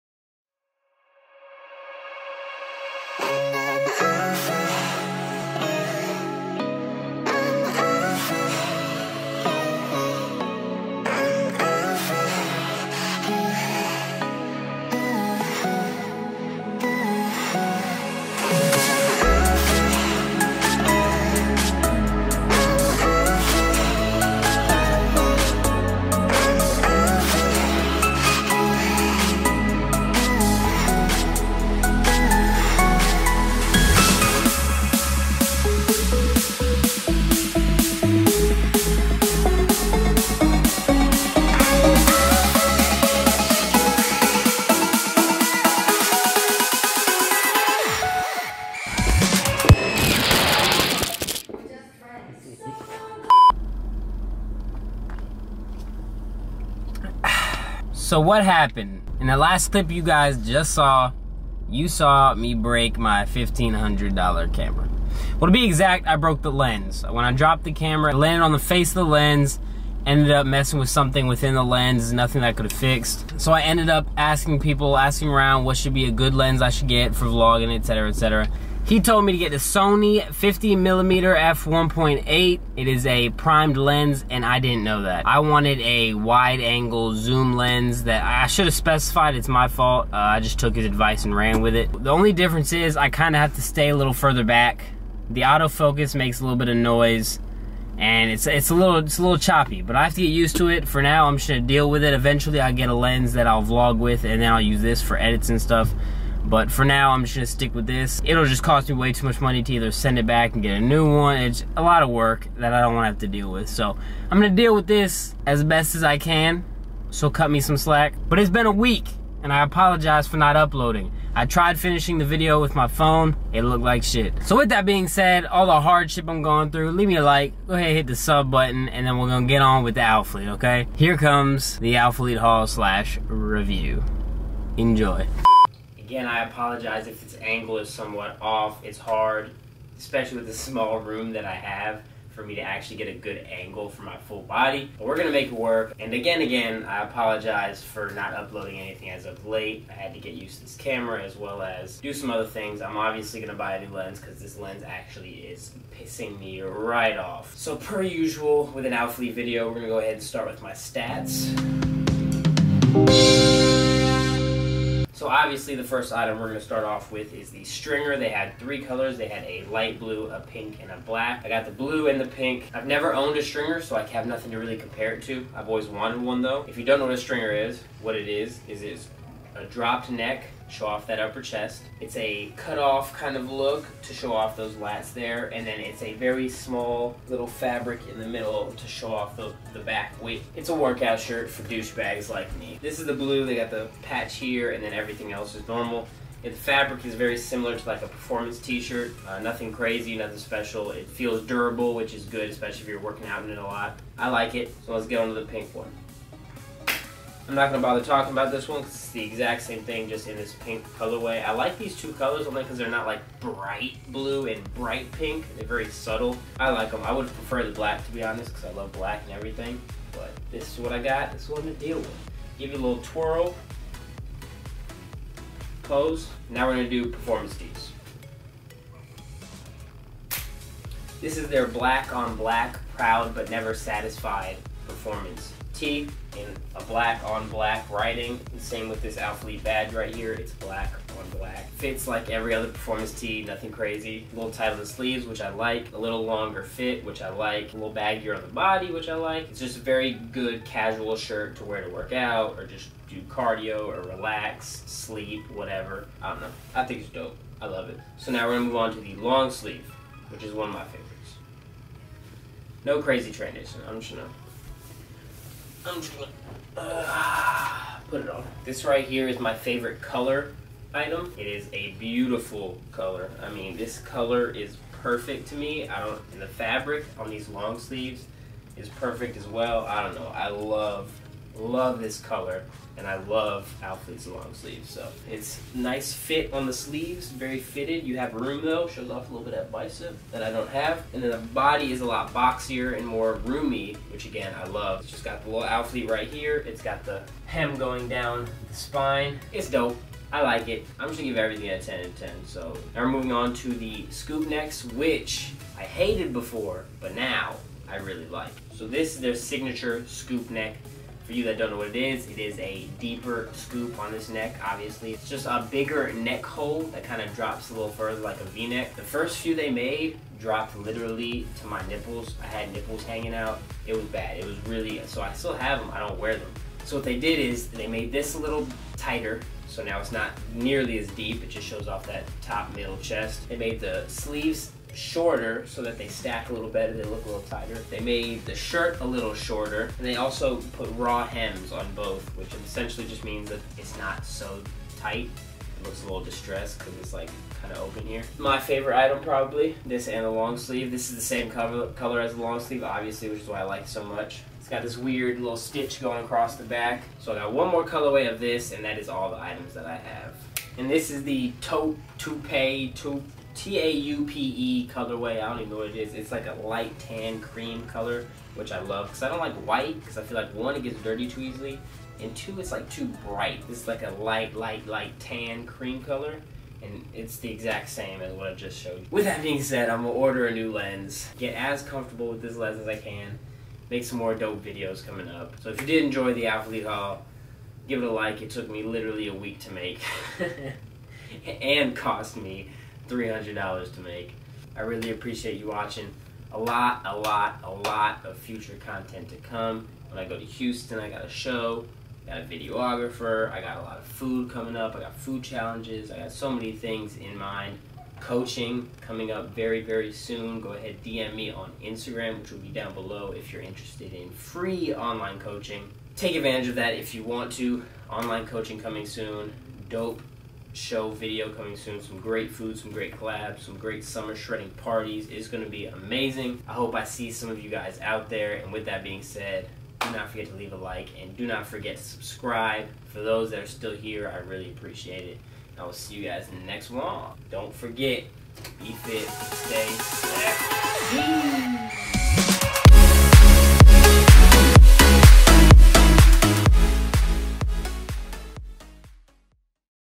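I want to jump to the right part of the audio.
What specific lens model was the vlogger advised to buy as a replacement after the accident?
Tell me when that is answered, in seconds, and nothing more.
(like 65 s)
79 s.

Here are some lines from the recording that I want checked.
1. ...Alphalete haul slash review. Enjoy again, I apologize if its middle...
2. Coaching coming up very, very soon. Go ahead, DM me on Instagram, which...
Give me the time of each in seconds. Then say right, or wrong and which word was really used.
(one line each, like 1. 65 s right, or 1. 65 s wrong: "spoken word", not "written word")
1. 131 s wrong: "angle", not "middle"
2. 408 s right.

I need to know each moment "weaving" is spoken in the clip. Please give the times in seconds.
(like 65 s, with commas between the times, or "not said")
not said.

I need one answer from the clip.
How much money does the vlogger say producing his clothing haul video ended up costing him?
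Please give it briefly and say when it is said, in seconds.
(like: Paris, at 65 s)
$300, at 393 s.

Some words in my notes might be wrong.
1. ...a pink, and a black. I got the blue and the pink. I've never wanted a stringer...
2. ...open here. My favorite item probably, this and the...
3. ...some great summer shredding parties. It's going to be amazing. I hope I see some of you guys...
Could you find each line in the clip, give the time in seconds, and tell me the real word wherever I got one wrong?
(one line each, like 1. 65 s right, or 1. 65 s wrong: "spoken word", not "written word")
1. 170 s wrong: "owned", not "wanted"
2. 347 s right
3. 423 s right.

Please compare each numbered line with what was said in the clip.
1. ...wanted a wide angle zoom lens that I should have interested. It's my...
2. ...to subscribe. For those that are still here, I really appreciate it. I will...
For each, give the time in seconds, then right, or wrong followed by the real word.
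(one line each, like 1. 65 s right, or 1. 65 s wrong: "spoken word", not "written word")
1. 85 s wrong: "specified", not "interested"
2. 431 s right.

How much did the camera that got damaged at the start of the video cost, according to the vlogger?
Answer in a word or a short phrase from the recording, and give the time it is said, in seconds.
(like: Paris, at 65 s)
$1,500, at 63 s.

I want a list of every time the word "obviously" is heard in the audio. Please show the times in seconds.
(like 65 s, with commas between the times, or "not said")
152 s, 165 s, 314 s, 352 s.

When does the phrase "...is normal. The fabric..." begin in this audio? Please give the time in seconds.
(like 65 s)
195 s.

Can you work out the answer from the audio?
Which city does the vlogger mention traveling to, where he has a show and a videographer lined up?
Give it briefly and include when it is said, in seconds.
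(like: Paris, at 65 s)
Houston, at 400 s.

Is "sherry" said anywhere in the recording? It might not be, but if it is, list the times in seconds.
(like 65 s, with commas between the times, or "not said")
not said.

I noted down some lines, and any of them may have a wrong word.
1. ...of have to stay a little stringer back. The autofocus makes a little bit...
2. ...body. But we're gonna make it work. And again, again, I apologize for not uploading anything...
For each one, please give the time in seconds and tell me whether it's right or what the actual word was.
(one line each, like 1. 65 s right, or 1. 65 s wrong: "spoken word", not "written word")
1. 93 s wrong: "further", not "stringer"
2. 144 s right.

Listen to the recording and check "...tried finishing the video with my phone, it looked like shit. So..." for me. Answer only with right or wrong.
right.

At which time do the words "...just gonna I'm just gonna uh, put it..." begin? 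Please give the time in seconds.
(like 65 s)
264 s.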